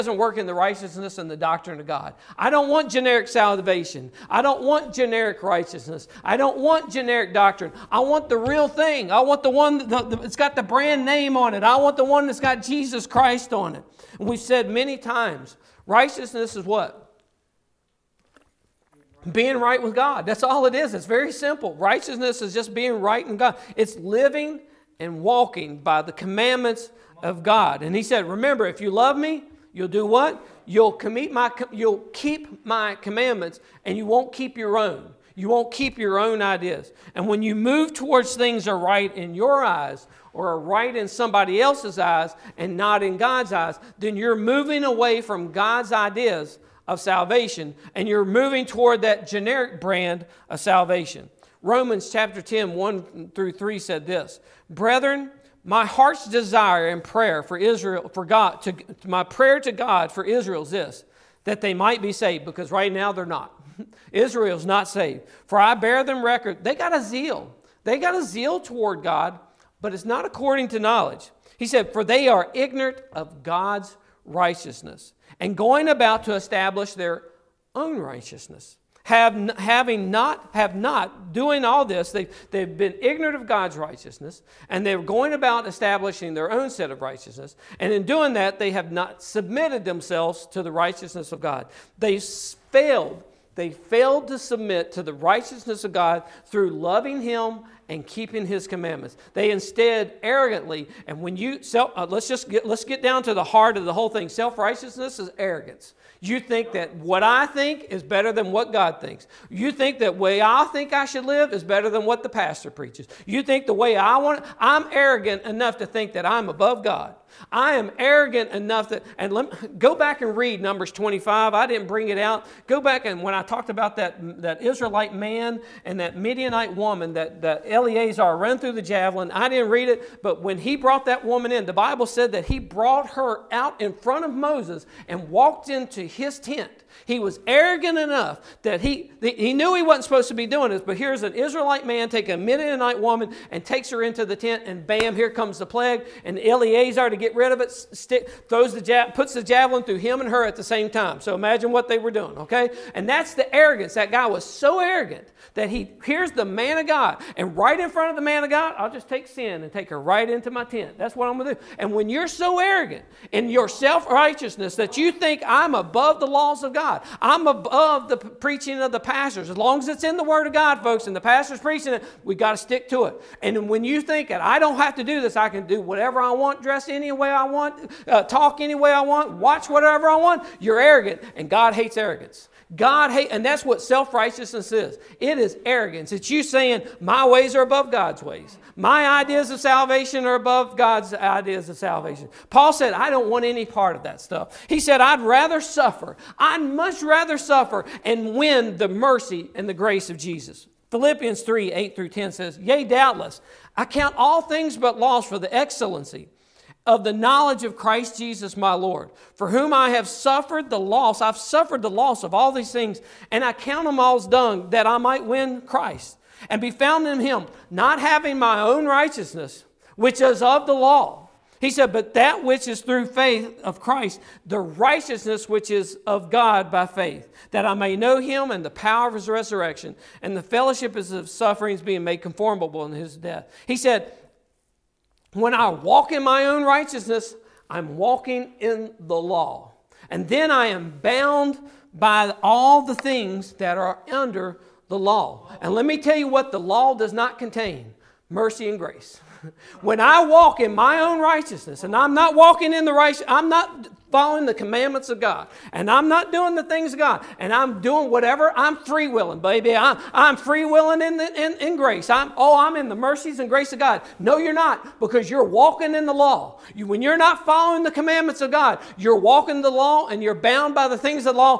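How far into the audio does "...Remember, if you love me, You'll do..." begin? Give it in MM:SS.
00:28.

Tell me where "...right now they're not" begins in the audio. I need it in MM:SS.
01:02.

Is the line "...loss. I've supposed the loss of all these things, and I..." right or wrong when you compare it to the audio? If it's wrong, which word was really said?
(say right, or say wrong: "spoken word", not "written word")
wrong: "suffered", not "supposed".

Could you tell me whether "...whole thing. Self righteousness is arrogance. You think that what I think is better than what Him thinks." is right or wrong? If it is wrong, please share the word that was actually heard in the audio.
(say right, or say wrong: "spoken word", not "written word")
wrong: "God", not "Him".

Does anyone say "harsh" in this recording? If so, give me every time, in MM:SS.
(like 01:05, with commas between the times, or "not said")
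not said.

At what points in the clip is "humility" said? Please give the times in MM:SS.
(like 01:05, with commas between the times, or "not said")
not said.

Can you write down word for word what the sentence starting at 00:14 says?
And we've said many times righteousness is what?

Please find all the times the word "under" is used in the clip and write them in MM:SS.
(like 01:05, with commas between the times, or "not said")
04:04.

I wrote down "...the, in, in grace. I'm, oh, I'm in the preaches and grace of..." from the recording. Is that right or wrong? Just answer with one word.
wrong.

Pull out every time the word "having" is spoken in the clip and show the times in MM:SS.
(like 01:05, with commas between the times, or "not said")
01:19, 03:37.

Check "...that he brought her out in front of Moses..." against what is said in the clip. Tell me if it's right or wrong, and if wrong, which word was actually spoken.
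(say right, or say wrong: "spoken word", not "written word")
right.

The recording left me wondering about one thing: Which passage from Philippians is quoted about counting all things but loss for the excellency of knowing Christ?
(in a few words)
Philippians 3:8-10.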